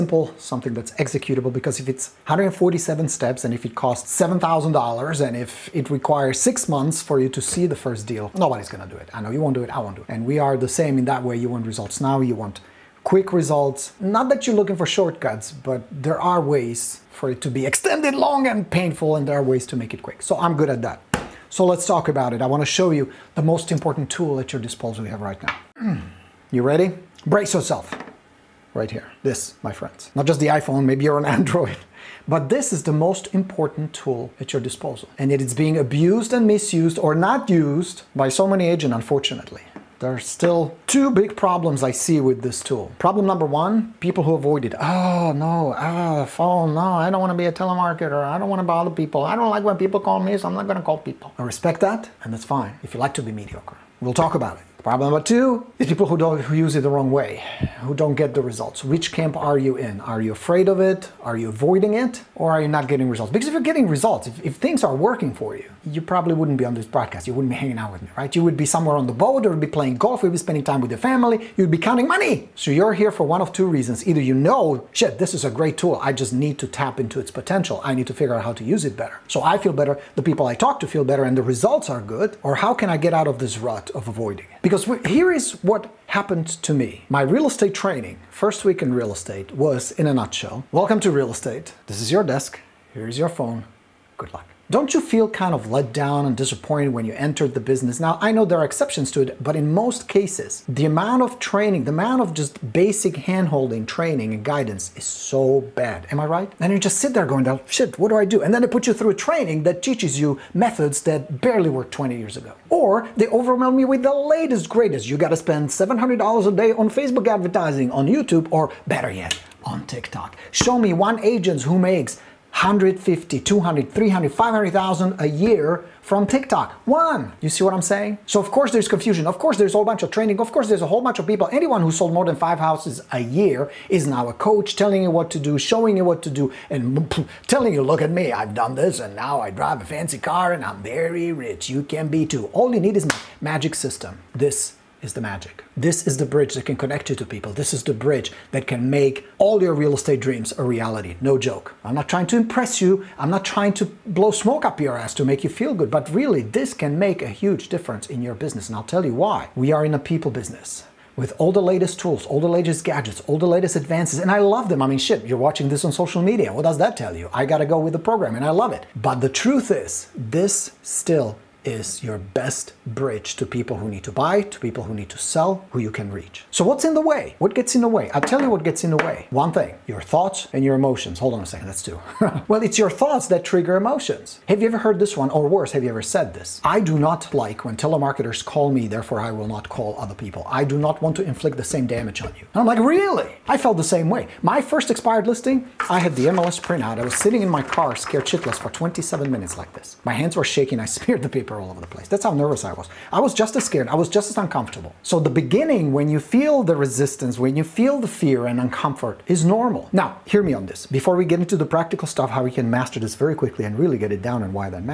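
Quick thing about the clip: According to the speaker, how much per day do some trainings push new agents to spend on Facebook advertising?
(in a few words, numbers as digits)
$700.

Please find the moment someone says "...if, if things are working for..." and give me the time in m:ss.
1:04.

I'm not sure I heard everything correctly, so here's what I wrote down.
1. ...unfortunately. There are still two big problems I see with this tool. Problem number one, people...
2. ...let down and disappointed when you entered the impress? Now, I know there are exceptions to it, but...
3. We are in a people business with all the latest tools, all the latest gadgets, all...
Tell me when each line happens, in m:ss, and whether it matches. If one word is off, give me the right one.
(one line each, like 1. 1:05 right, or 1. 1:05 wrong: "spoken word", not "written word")
1. 0:38 right
2. 1:35 wrong: "business", not "impress"
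3. 2:39 right.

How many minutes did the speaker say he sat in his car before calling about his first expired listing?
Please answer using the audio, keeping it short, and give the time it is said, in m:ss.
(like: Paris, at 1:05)
27, at 3:18.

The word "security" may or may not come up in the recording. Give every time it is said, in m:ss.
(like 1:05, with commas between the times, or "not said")
not said.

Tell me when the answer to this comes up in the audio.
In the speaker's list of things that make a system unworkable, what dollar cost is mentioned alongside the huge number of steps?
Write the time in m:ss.
0:04.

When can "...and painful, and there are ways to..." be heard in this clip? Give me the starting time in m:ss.
0:18.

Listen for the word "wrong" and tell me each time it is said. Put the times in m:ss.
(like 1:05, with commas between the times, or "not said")
0:56.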